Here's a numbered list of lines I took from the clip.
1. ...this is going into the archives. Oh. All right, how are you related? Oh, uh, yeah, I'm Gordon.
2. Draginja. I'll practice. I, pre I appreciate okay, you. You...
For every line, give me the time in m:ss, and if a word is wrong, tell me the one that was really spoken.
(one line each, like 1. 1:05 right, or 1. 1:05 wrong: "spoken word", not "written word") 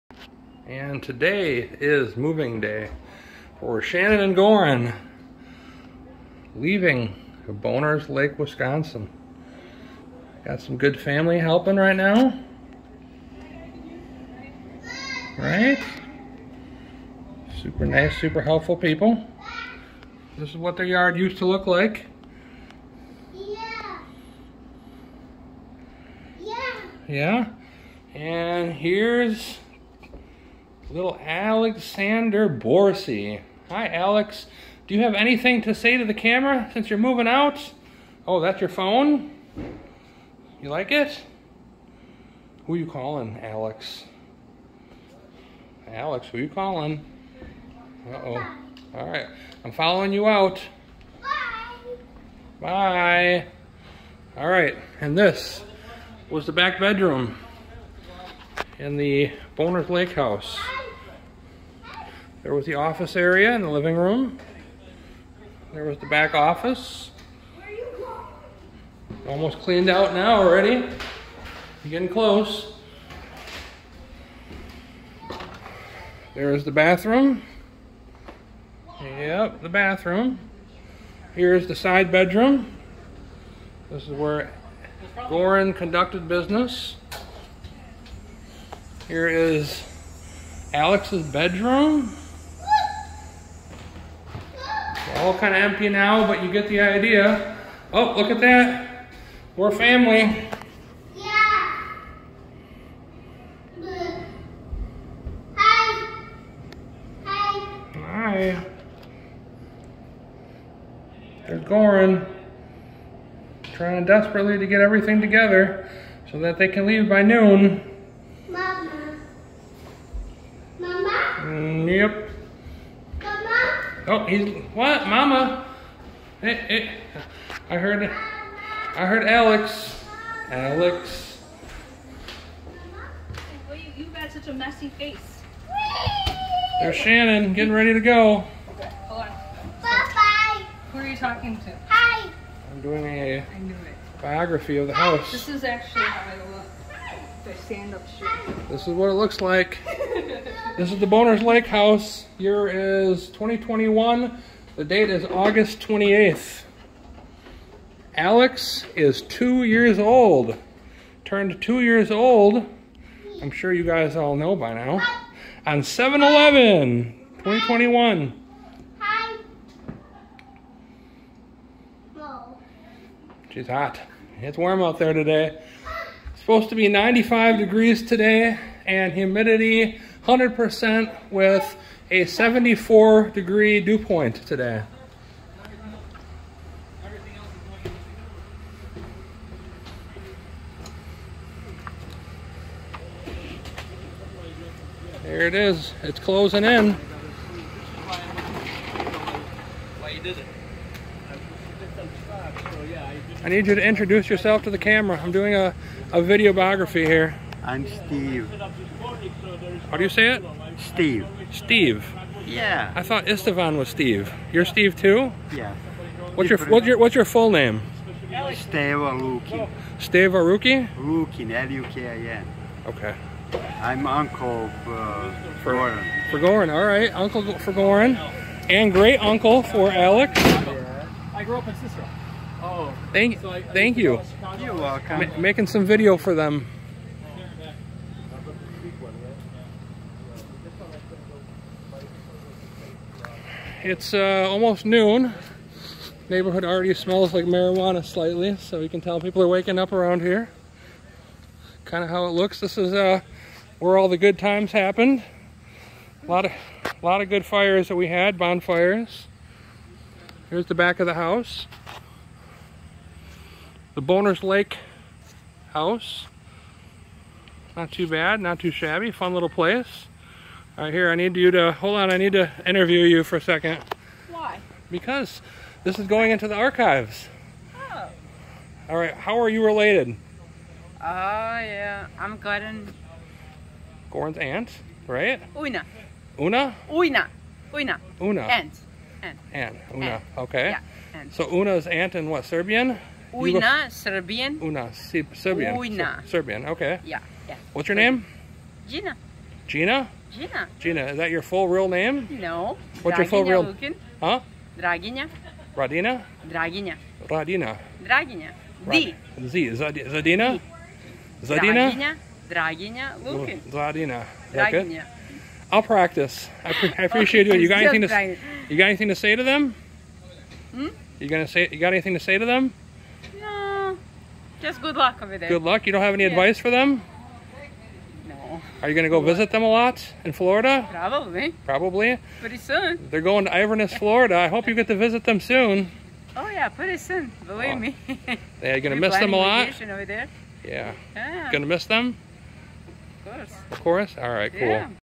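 1. 4:35 right
2. 5:14 right.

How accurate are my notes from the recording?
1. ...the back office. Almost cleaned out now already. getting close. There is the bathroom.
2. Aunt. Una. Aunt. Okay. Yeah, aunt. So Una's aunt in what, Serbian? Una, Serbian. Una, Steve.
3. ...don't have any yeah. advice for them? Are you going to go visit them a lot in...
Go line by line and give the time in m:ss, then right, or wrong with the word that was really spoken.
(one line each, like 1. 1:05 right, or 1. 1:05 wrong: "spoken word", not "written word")
1. 1:05 right
2. 4:49 wrong: "Serbian", not "Steve"
3. 5:25 right.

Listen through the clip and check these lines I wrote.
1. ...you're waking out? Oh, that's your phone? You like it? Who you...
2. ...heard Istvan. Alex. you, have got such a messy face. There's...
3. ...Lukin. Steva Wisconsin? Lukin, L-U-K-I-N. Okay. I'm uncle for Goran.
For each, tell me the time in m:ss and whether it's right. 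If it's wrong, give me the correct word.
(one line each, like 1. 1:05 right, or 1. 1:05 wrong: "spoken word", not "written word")
1. 0:36 wrong: "moving", not "waking"
2. 2:09 wrong: "Alex", not "Istvan"
3. 3:39 wrong: "Ruki", not "Wisconsin".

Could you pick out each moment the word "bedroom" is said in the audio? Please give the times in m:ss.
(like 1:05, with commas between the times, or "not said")
0:56, 1:22, 1:31.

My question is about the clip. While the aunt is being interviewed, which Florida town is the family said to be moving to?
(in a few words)
Inverness.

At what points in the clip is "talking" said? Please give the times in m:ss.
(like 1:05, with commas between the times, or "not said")
2:21.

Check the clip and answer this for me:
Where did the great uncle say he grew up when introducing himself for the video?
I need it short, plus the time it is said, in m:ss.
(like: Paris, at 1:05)
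Cicero, at 3:51.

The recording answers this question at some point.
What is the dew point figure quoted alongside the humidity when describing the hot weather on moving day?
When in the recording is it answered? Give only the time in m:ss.
3:02.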